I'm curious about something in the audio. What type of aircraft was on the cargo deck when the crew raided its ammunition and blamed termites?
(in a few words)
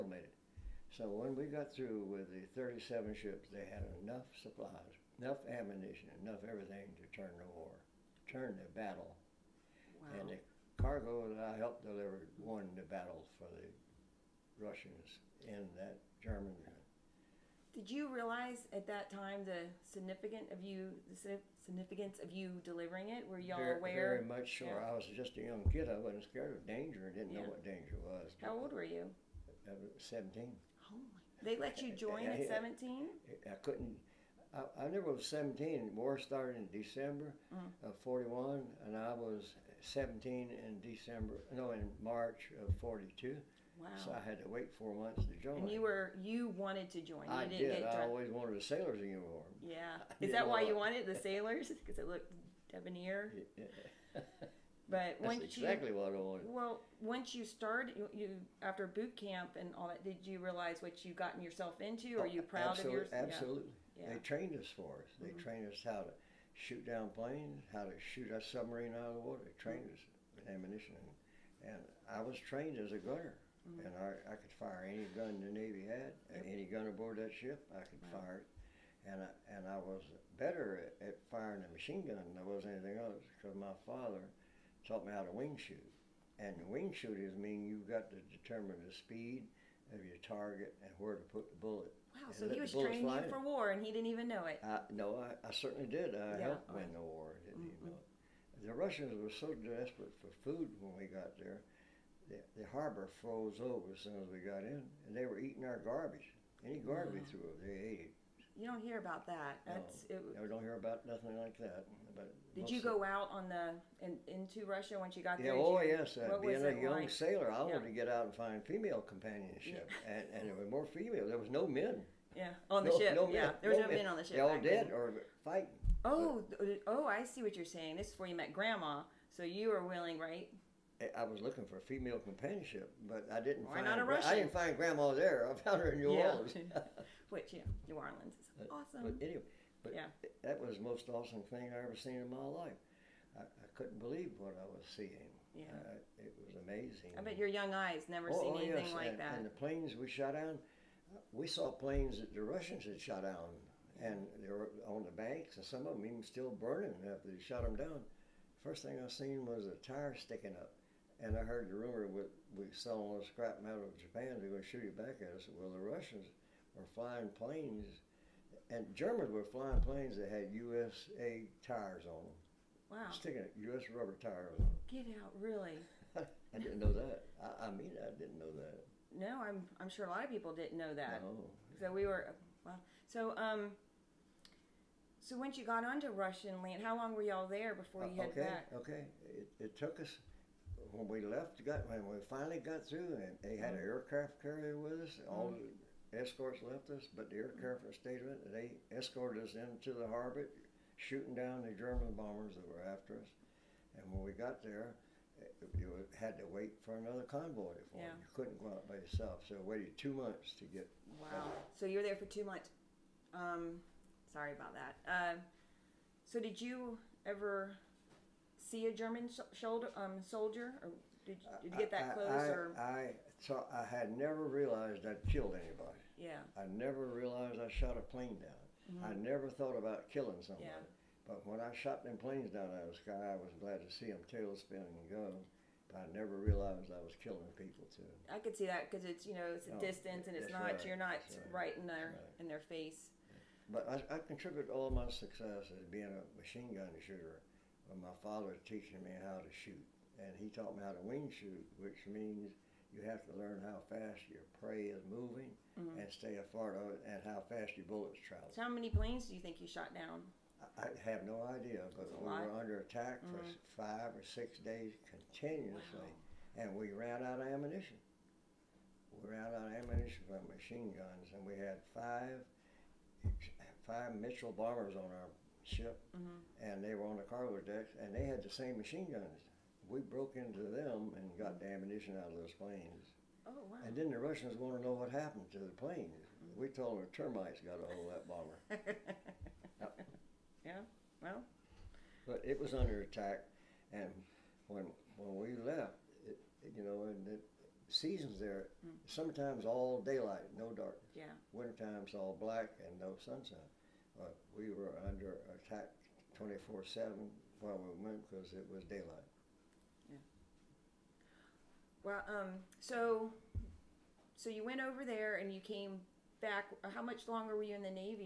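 Mitchell bombers.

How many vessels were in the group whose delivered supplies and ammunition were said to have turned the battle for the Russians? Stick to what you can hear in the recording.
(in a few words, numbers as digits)
37.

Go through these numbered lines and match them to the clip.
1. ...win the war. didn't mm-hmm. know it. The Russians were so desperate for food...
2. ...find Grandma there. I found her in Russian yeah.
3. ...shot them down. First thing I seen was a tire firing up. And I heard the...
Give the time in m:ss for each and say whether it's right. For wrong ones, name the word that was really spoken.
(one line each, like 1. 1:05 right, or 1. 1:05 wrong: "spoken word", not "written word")
1. 1:36 right
2. 2:14 wrong: "New", not "Russian"
3. 2:37 wrong: "sticking", not "firing".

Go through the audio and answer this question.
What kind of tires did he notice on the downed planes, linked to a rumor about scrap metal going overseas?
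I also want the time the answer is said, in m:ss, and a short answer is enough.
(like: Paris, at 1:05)
USA tires, at 2:50.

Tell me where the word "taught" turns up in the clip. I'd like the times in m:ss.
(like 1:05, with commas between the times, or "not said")
1:24, 4:10.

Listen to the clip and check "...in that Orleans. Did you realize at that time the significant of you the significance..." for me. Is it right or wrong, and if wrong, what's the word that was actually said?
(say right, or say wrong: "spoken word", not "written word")
wrong: "German", not "Orleans".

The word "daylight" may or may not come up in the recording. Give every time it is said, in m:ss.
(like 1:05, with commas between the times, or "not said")
5:00, 5:08.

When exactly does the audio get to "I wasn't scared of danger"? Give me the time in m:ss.
0:25.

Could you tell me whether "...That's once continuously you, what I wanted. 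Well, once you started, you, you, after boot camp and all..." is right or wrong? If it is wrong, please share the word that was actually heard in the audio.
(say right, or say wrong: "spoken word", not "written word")
wrong: "exactly", not "continuously".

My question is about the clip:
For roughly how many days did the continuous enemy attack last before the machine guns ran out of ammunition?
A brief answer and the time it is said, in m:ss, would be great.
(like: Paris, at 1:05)
5 or 6, at 4:23.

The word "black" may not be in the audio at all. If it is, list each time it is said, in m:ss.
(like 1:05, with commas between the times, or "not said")
5:02.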